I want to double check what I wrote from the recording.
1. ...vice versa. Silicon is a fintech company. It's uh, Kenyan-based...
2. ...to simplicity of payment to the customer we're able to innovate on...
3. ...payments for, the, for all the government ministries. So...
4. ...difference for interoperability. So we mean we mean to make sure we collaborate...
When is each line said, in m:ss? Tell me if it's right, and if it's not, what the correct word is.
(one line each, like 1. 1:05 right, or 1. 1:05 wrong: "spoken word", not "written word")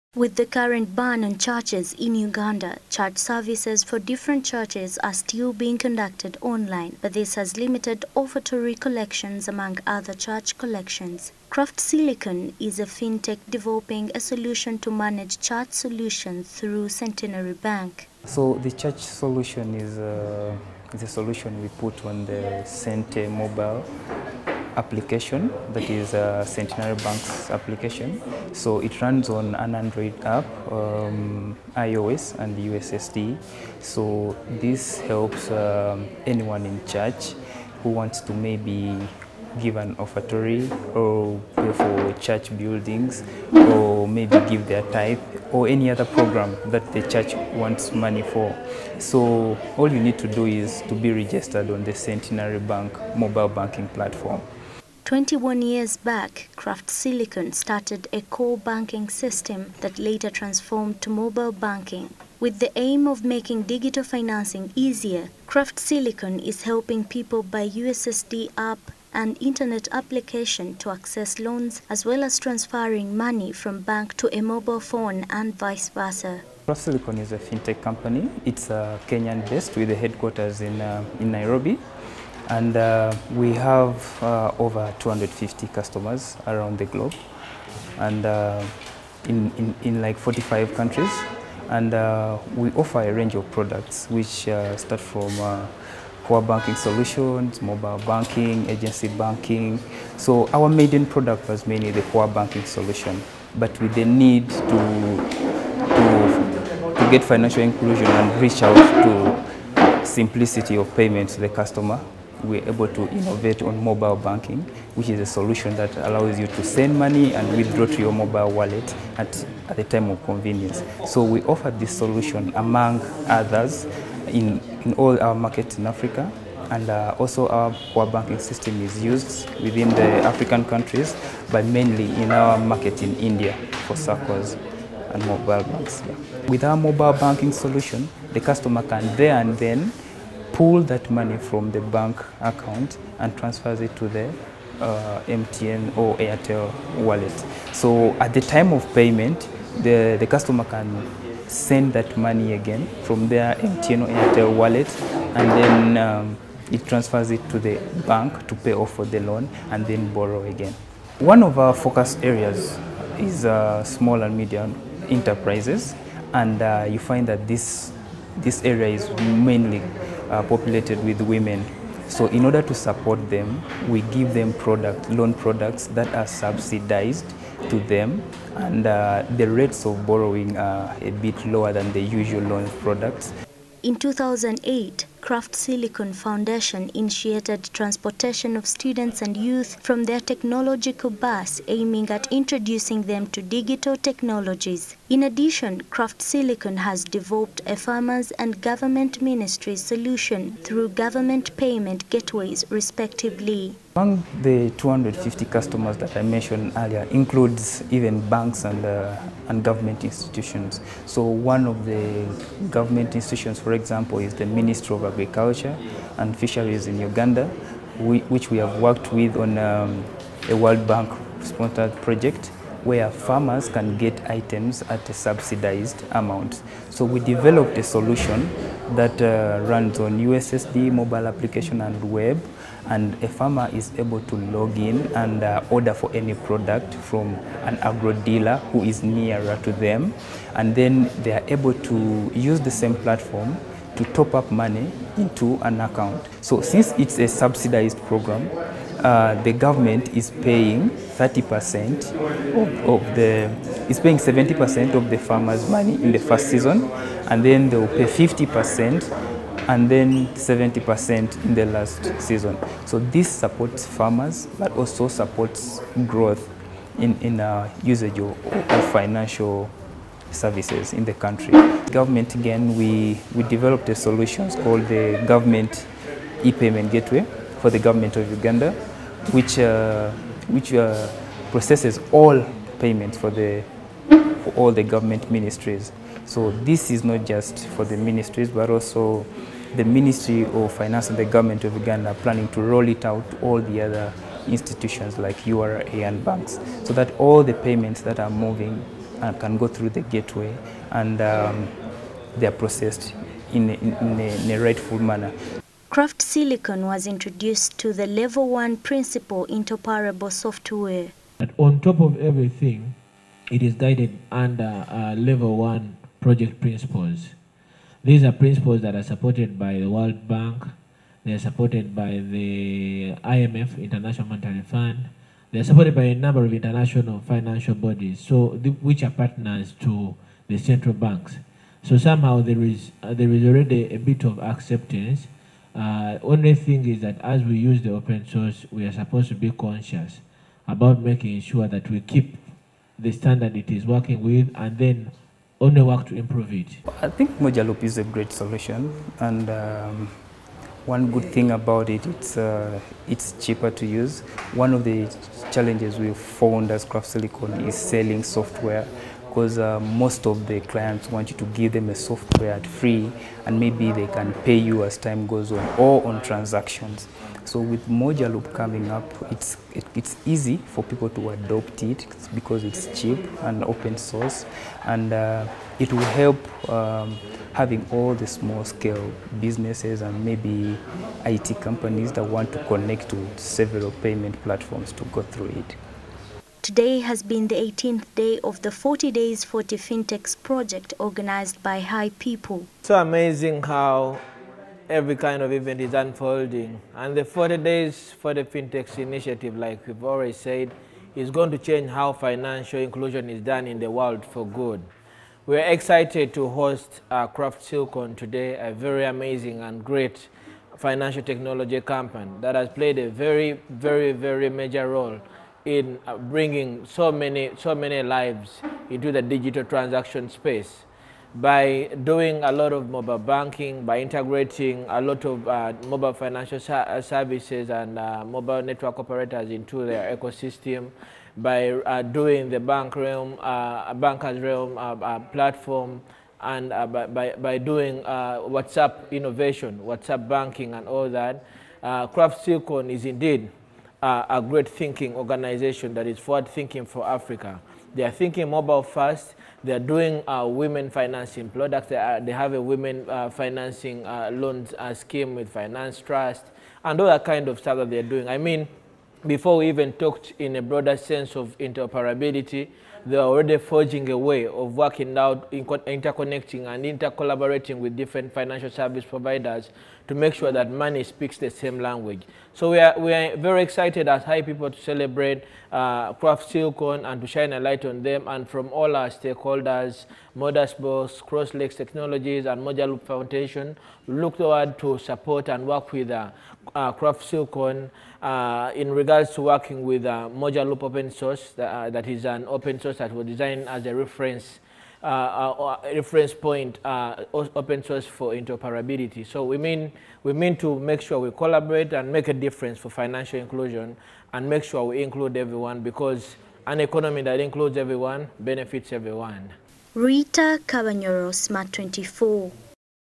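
1. 1:15 right
2. 1:48 right
3. 4:42 right
4. 8:17 wrong: "source", not "difference".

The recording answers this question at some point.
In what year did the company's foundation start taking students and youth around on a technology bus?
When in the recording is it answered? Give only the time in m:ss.
3:03.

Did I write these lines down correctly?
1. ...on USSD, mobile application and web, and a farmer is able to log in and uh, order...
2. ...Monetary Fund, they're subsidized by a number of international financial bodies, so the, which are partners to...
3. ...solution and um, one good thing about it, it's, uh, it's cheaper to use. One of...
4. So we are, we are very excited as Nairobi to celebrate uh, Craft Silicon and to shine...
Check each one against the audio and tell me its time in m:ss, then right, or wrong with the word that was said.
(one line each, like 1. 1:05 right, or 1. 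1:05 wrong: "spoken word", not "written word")
1. 3:49 right
2. 5:24 wrong: "supported", not "subsidized"
3. 5:48 right
4. 7:52 wrong: "HiPipo", not "Nairobi".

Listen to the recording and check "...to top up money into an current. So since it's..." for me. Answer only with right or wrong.
wrong.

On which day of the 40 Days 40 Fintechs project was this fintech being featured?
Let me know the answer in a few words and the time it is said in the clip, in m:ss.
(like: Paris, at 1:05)
18th, at 6:27.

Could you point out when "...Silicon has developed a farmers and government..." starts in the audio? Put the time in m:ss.
3:16.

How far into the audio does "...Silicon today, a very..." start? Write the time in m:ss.
6:47.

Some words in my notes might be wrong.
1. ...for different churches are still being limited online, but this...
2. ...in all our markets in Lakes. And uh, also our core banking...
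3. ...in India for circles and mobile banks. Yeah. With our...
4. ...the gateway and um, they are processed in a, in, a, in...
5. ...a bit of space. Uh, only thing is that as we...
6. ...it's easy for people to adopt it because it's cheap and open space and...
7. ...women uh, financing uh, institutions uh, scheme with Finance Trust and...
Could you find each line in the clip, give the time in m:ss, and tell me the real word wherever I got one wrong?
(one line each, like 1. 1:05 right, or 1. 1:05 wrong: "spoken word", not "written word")
1. 0:03 wrong: "conducted", not "limited"
2. 2:04 wrong: "Africa", not "Lakes"
3. 2:13 right
4. 4:59 right
5. 5:33 wrong: "acceptance", not "space"
6. 6:09 wrong: "source", not "space"
7. 7:32 wrong: "loans", not "institutions".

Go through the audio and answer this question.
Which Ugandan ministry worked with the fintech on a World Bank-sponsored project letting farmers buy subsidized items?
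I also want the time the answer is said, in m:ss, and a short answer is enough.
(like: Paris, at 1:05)
Ministry of Agriculture and Fisheries, at 3:34.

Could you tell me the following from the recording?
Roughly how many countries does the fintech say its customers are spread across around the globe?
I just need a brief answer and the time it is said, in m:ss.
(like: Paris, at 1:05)
45, at 1:30.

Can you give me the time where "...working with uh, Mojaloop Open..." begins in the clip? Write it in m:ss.
8:09.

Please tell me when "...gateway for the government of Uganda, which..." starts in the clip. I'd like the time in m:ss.
4:36.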